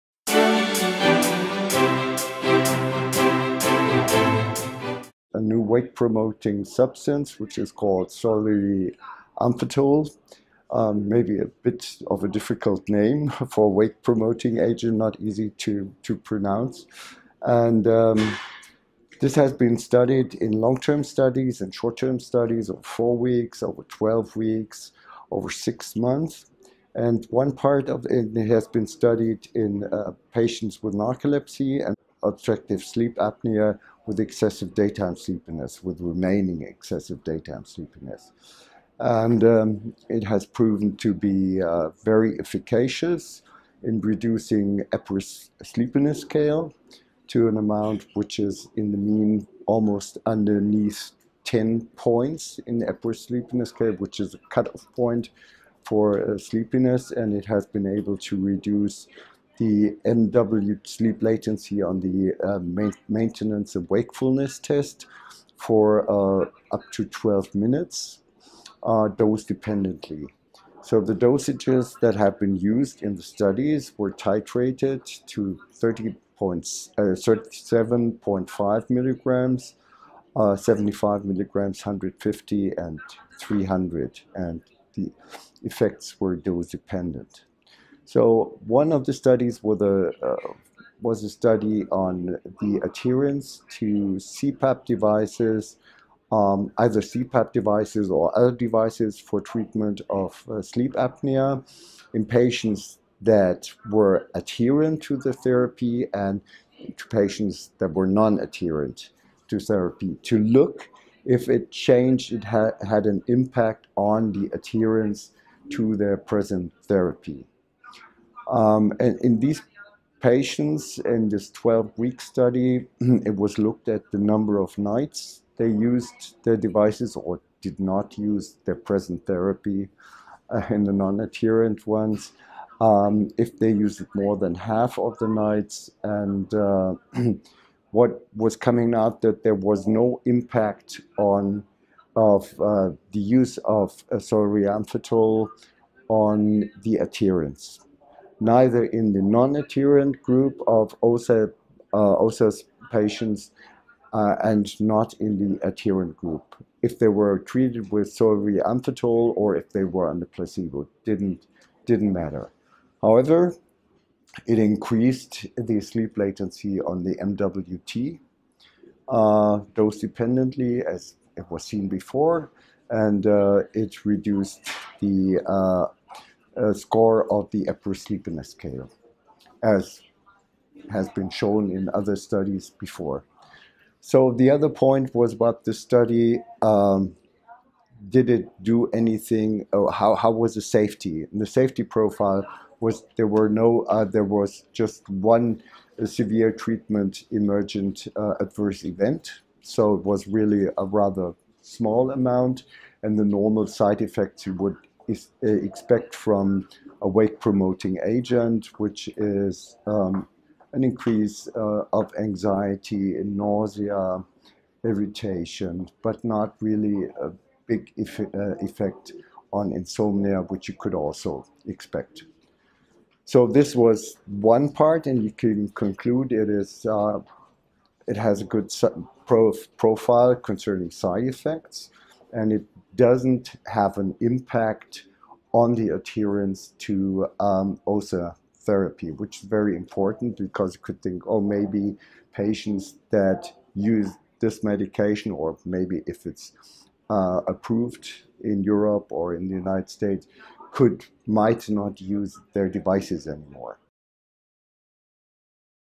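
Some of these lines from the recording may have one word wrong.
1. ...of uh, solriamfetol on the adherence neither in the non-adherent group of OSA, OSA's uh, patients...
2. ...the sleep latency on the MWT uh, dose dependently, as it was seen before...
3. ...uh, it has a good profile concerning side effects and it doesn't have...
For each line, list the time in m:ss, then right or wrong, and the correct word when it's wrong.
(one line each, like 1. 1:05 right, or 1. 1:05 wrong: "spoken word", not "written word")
1. 2:23 right
2. 2:45 right
3. 3:46 right.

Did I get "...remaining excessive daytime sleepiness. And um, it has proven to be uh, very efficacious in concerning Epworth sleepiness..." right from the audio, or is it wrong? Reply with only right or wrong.
wrong.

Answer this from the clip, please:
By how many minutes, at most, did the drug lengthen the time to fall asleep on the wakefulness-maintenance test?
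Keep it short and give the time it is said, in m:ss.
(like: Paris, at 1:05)
12 minutes, at 1:07.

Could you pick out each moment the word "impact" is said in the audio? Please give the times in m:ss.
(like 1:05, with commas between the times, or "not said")
1:53, 2:20, 3:54.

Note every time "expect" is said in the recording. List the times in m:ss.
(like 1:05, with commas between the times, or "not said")
3:25, 3:41.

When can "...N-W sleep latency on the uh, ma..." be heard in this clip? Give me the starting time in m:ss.
1:00.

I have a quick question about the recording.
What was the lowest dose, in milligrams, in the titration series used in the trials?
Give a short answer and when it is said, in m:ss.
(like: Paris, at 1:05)
37.5 mg, at 1:15.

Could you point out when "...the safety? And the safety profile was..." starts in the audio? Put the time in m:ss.
3:10.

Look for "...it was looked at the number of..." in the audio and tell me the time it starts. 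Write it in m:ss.
2:02.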